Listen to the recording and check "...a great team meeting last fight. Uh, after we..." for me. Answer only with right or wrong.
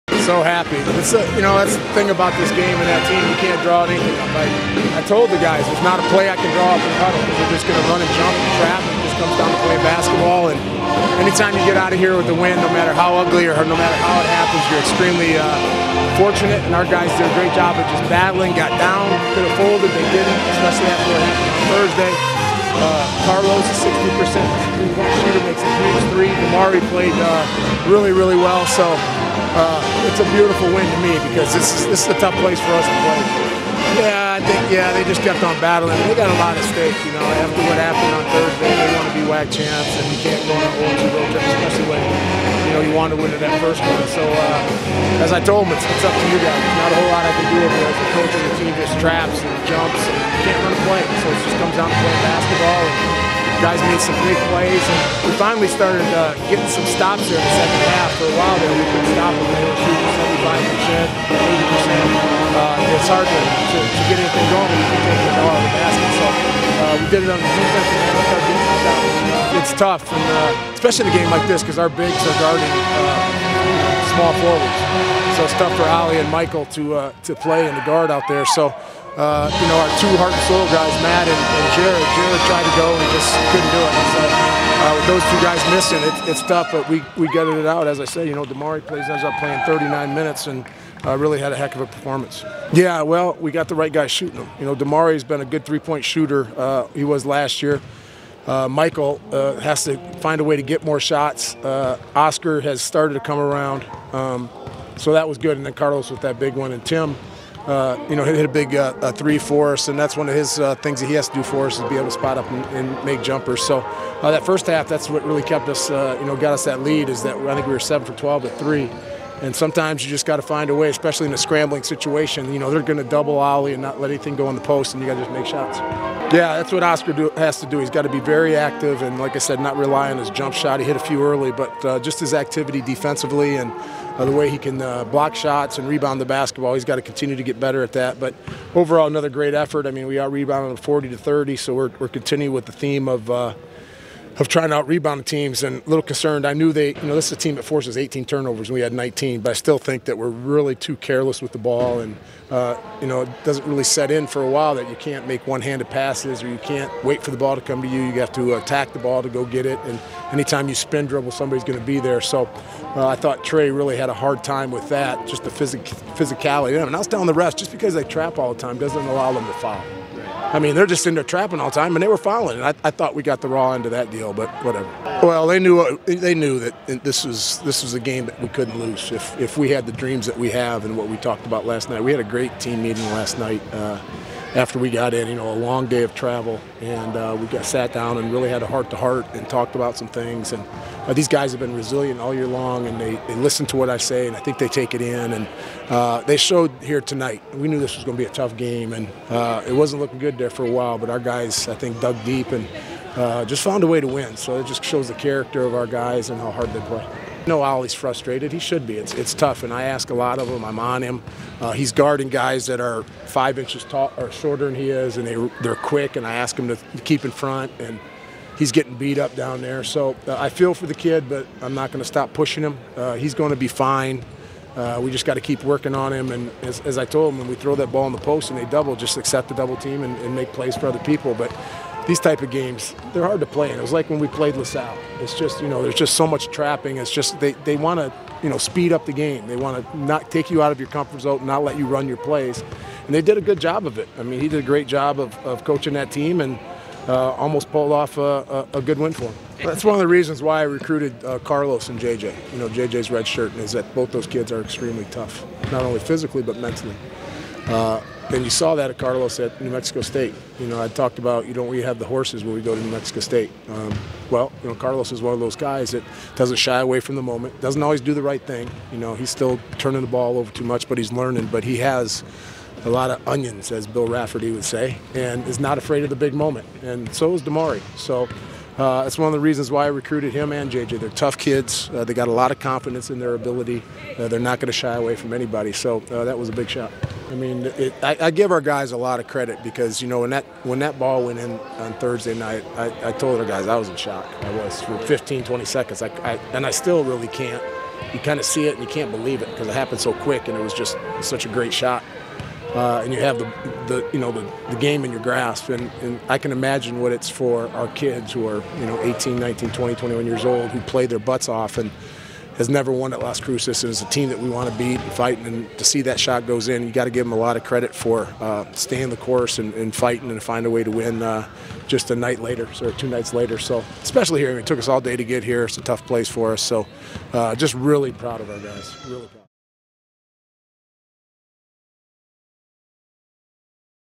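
wrong.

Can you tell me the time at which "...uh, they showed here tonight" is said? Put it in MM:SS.
03:15.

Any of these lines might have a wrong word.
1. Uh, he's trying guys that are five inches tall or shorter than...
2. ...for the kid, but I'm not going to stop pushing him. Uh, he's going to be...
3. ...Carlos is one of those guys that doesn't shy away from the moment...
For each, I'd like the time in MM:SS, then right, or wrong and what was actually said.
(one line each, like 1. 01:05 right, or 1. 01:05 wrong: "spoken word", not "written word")
1. 03:31 wrong: "guarding", not "trying"
2. 03:40 right
3. 04:24 right.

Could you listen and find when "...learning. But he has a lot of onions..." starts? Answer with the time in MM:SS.
04:31.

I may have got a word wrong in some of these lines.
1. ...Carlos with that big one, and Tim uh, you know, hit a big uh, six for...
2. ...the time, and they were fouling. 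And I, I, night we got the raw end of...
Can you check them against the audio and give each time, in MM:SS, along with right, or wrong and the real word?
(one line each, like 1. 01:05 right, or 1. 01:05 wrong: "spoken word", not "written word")
1. 01:45 wrong: "three", not "six"
2. 02:51 wrong: "thought", not "night".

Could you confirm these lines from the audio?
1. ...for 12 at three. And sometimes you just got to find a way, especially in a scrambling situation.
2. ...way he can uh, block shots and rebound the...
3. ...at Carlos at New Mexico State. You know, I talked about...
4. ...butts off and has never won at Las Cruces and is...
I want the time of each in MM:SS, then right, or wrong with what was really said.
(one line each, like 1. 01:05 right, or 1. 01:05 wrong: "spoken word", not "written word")
1. 01:58 right
2. 02:14 right
3. 04:18 right
4. 05:11 right.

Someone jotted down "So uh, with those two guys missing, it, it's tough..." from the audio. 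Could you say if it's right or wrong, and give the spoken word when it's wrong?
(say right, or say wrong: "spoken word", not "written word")
right.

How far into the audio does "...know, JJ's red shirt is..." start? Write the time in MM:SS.
04:12.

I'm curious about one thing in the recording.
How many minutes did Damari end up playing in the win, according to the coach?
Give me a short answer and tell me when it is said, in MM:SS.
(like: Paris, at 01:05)
39, at 01:29.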